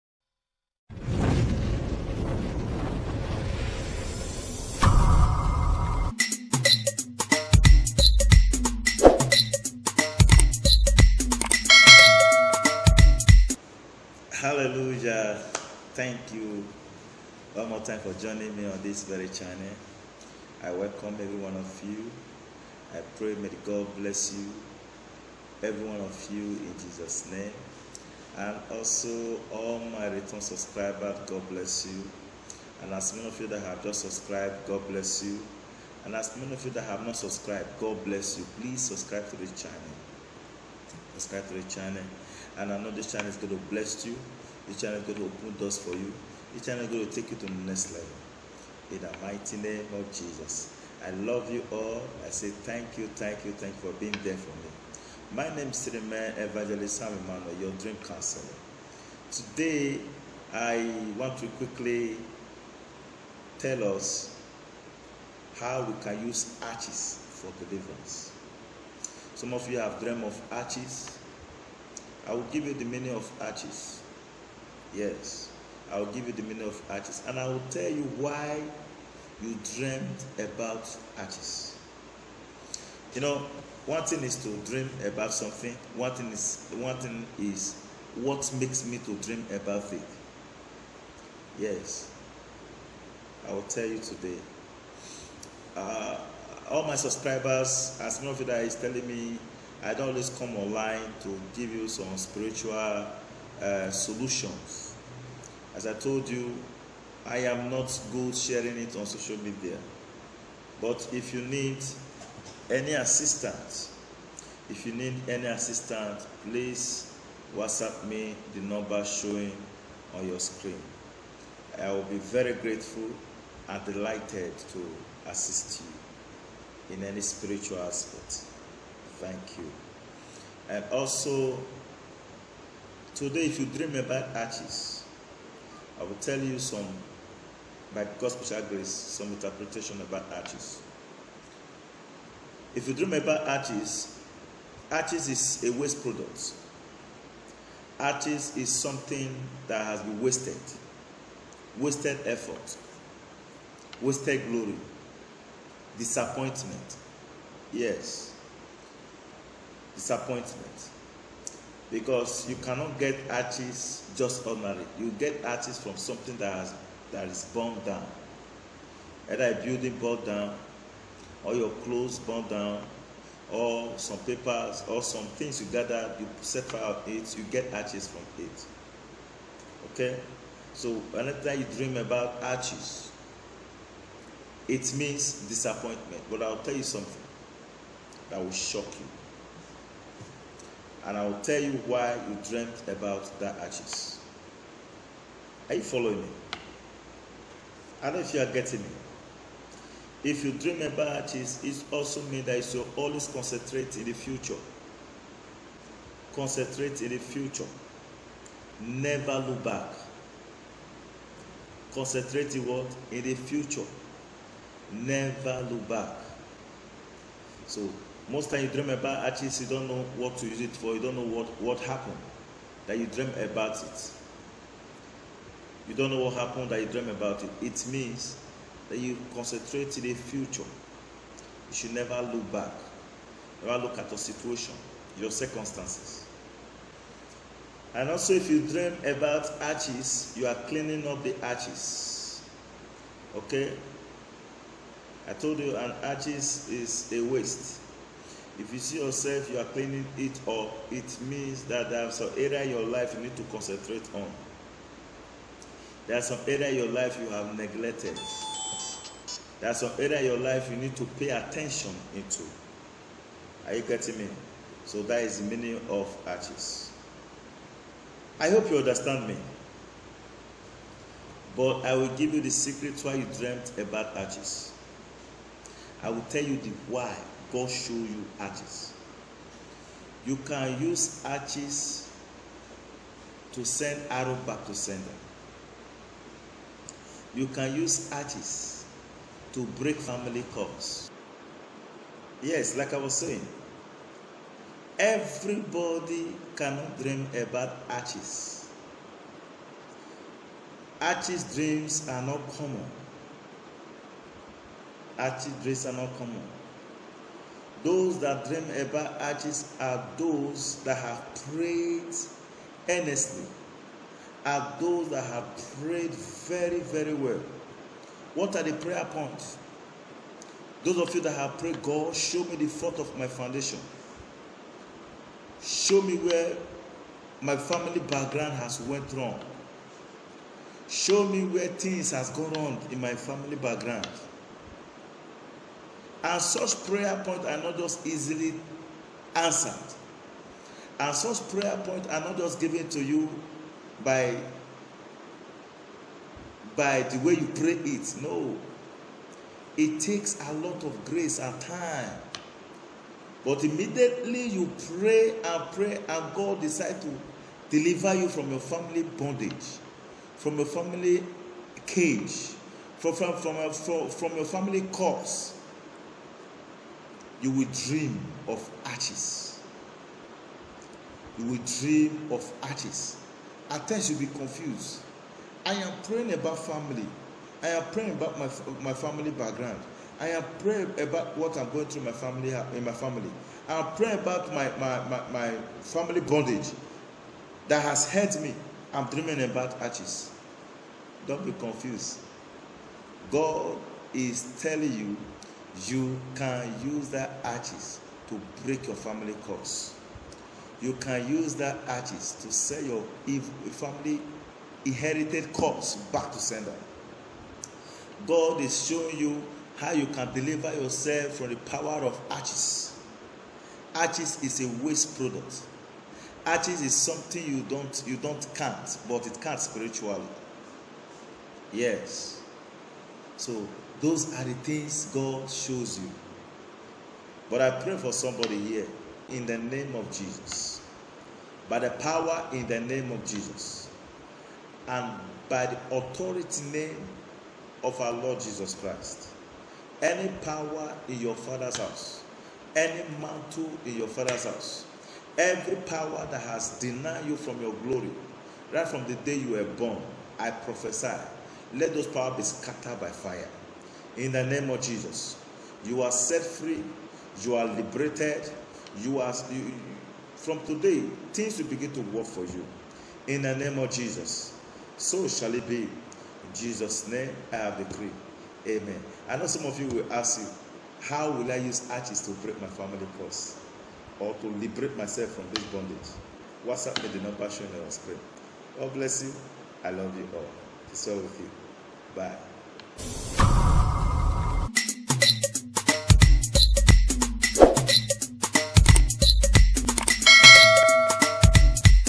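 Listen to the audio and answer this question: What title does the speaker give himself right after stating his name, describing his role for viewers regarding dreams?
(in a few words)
your dream counselor.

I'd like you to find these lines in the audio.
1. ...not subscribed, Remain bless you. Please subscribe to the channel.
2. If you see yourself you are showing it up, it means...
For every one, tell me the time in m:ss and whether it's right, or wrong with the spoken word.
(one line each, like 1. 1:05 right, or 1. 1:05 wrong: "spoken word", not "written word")
1. 0:37 wrong: "God", not "Remain"
2. 4:08 wrong: "cleaning", not "showing".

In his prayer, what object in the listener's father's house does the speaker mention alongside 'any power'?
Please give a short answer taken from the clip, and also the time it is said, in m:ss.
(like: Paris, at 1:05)
any mantle, at 7:22.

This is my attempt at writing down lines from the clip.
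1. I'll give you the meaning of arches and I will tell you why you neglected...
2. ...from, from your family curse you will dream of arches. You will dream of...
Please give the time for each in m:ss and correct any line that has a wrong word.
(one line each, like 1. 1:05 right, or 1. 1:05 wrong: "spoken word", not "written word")
1. 1:15 wrong: "dreamed", not "neglected"
2. 6:03 right.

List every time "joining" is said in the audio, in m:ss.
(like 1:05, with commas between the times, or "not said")
0:18.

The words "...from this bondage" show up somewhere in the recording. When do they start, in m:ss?
7:55.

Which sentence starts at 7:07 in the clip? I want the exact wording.
But I pray for somebody here in the name of Jesus.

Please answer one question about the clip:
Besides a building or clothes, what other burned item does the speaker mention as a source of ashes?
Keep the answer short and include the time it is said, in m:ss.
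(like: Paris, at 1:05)
some papers, at 2:53.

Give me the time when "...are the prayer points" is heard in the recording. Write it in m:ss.
5:18.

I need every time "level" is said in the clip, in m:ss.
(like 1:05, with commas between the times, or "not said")
0:47.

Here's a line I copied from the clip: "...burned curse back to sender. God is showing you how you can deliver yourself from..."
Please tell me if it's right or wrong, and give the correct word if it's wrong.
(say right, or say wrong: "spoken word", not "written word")
wrong: "inherited", not "burned".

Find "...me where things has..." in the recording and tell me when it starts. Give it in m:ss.
5:31.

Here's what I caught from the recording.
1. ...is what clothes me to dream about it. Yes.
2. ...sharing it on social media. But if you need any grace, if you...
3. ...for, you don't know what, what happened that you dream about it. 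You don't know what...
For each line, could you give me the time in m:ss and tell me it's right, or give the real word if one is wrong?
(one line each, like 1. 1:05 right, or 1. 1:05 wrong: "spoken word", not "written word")
1. 1:27 wrong: "makes", not "clothes"
2. 1:48 wrong: "assistance", not "grace"
3. 3:40 right.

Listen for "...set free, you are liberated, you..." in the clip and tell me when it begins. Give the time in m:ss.
7:36.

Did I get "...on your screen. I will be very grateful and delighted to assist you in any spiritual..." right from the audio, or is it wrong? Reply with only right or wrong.
right.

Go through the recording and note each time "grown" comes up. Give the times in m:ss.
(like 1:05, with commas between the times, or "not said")
not said.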